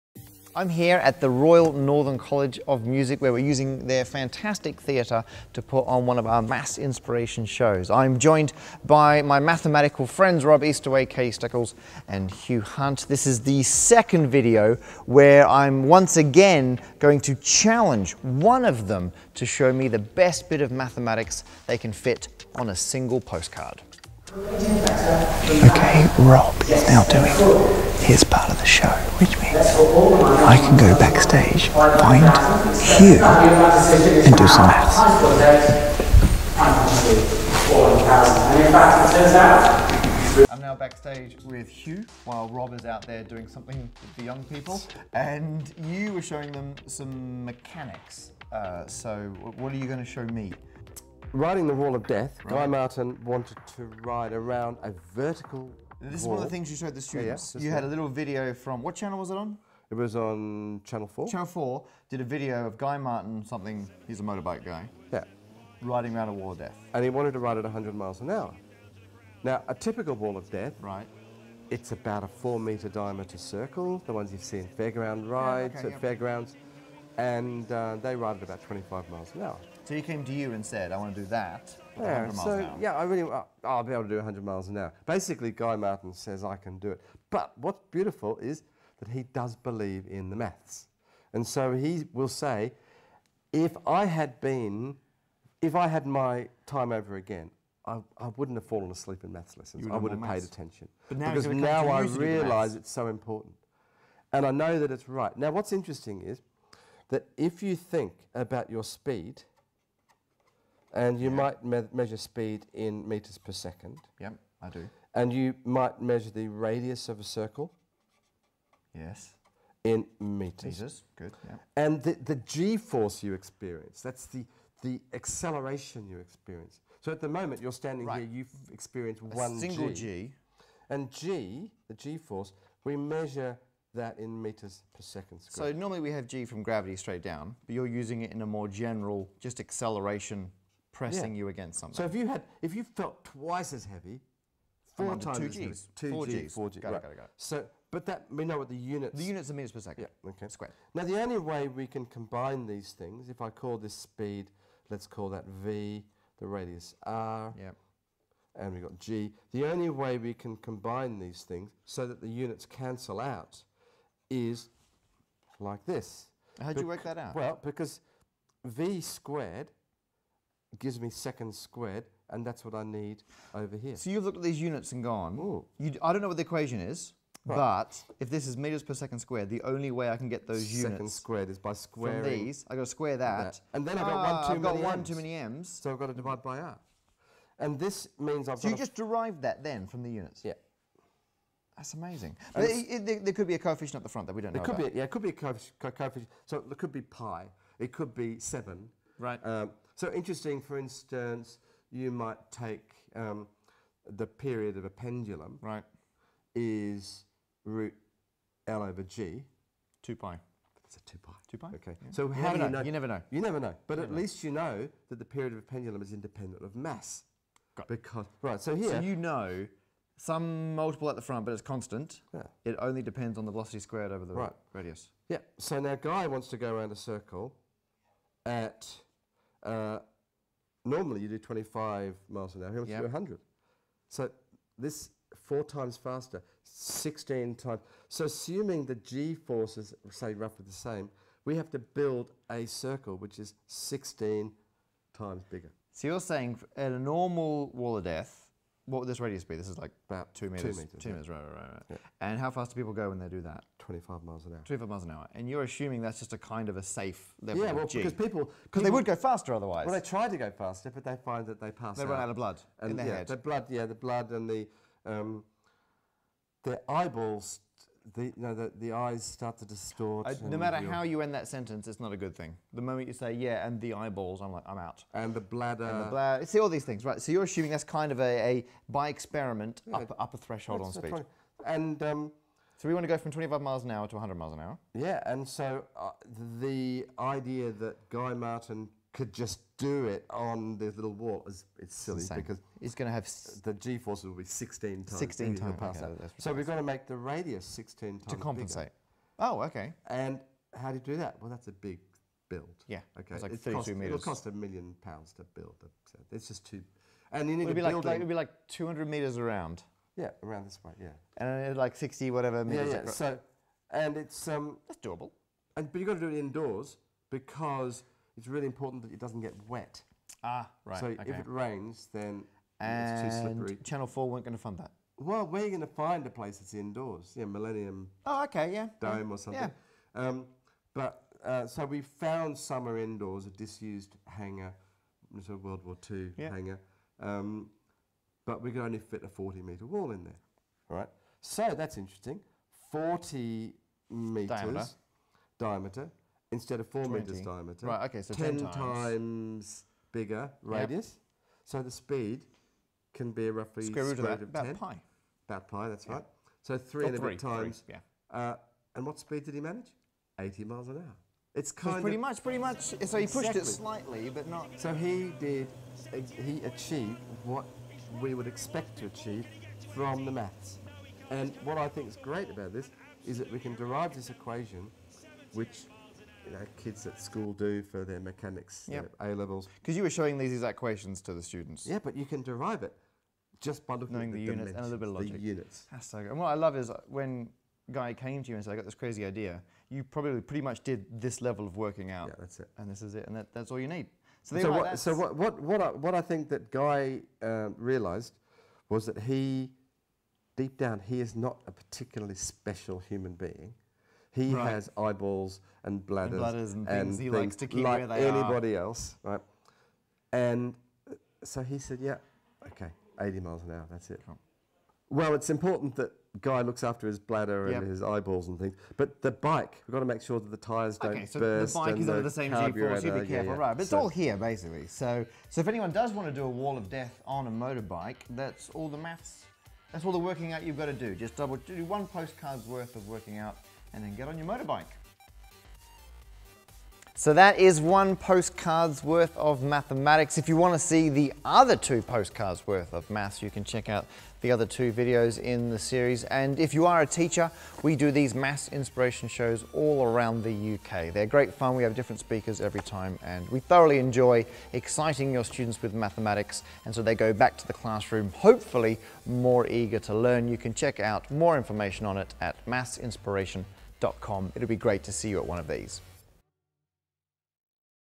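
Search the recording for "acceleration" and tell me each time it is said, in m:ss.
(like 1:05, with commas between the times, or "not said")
2:05, 2:19.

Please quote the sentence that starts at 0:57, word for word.
yeah, you had a little video from what channel was it on?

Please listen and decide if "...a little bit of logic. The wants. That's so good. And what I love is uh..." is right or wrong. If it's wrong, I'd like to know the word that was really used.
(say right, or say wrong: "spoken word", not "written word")
wrong: "units", not "wants".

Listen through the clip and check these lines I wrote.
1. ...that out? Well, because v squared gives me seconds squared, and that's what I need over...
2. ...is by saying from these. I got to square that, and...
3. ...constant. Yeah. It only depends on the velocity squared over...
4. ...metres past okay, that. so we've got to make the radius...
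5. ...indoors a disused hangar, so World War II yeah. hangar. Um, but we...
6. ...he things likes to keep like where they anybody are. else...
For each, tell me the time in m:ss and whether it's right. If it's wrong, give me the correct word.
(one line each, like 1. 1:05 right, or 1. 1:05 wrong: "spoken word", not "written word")
1. 2:47 right
2. 3:01 wrong: "squaring", not "saying"
3. 3:41 right
4. 4:55 wrong: "times", not "metres"
5. 5:32 right
6. 6:47 right.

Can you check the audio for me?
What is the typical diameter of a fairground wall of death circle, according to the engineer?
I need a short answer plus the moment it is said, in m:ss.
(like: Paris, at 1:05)
4 metres, at 1:12.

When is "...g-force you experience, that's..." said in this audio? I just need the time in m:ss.
2:02.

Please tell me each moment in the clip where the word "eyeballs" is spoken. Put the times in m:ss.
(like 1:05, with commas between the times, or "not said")
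4:26, 4:33, 6:44, 6:58.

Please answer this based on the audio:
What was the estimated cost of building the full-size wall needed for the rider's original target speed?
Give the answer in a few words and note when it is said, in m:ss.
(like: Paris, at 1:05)
a million pounds, at 5:04.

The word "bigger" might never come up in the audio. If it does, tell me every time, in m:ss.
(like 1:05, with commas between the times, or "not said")
4:05, 4:58, 5:50.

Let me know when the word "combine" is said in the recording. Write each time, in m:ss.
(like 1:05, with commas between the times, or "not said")
2:32, 2:40.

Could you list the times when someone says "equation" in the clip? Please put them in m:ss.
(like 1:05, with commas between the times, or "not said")
2:56, 6:14, 6:20.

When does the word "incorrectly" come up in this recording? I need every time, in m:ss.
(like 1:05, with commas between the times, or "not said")
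not said.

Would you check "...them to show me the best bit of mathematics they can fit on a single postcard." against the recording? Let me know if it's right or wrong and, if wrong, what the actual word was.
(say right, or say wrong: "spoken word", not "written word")
right.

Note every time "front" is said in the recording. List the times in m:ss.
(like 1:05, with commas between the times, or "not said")
3:14, 3:41.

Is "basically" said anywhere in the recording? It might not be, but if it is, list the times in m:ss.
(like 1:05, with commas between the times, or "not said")
1:25, 7:04.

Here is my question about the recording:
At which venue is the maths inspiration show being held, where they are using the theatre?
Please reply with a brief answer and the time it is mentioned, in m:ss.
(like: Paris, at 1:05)
Royal Northern College of Music, at 0:01.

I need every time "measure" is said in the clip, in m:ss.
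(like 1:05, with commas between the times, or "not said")
1:51, 1:56, 2:12.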